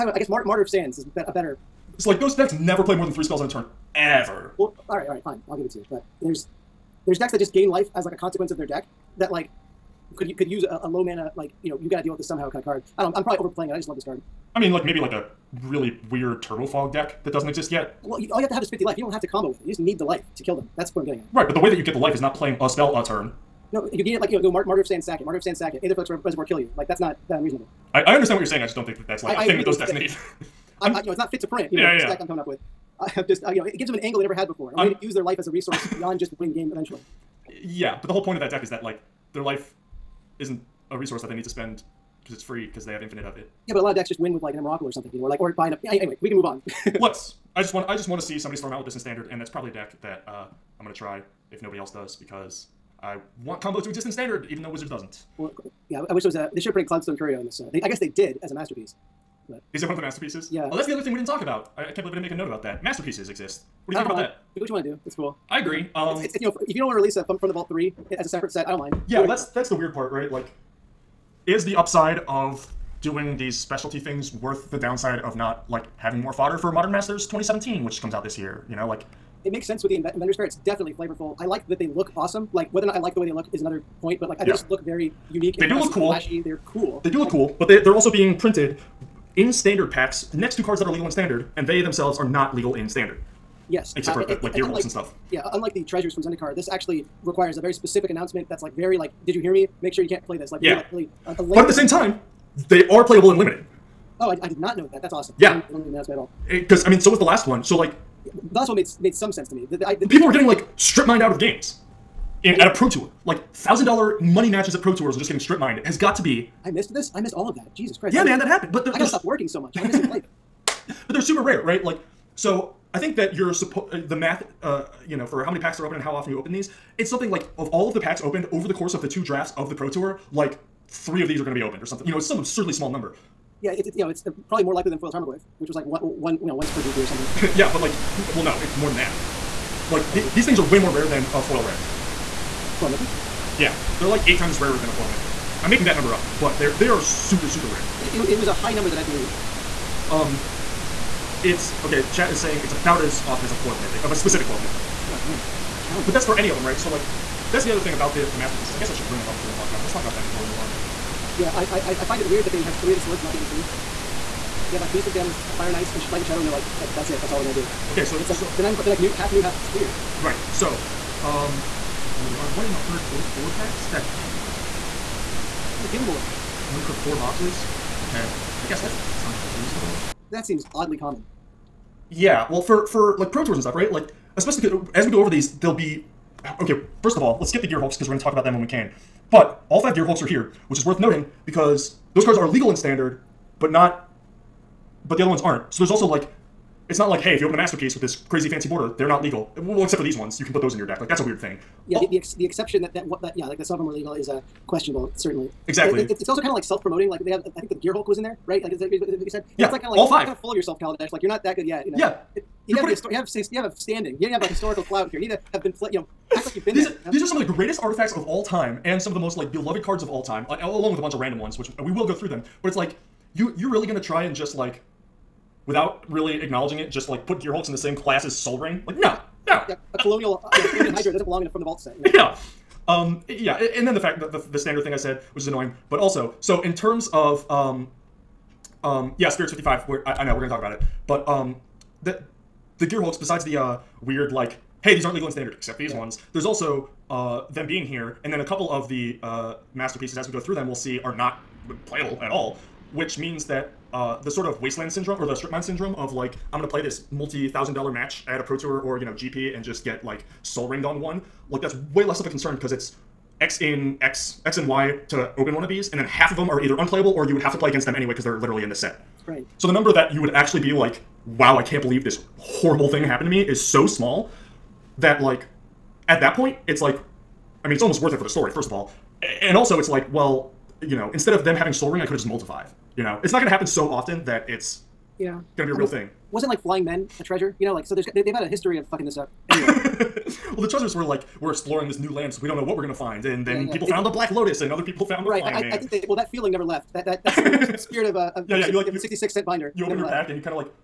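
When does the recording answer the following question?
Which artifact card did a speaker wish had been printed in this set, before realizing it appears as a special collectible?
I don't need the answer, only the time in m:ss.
0:56.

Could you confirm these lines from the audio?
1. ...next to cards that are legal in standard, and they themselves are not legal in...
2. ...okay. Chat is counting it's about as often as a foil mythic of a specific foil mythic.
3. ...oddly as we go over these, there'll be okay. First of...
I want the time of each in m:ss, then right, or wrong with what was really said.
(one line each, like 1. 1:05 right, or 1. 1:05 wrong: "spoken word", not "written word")
1. 1:30 right
2. 2:31 wrong: "saying", not "counting"
3. 3:04 wrong: "especially", not "oddly".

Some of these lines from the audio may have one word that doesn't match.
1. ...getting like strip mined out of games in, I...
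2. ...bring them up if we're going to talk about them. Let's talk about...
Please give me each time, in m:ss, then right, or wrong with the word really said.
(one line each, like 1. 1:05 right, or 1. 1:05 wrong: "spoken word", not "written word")
1. 1:50 right
2. 2:39 right.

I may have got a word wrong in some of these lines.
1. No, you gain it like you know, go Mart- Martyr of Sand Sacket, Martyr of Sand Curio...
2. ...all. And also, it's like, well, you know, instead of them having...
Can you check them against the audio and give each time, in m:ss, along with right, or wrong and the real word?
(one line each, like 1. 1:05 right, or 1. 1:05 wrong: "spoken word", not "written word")
1. 0:23 wrong: "Sacket", not "Curio"
2. 4:38 right.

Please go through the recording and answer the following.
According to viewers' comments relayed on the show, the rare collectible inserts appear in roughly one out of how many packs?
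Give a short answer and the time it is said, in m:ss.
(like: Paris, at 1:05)
144, at 2:52.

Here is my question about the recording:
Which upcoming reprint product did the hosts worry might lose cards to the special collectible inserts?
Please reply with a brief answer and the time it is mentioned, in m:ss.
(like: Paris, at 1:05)
Modern Masters 2017, at 1:16.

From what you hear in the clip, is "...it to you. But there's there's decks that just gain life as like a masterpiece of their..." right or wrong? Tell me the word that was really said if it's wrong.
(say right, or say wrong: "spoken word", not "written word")
wrong: "consequence", not "masterpiece".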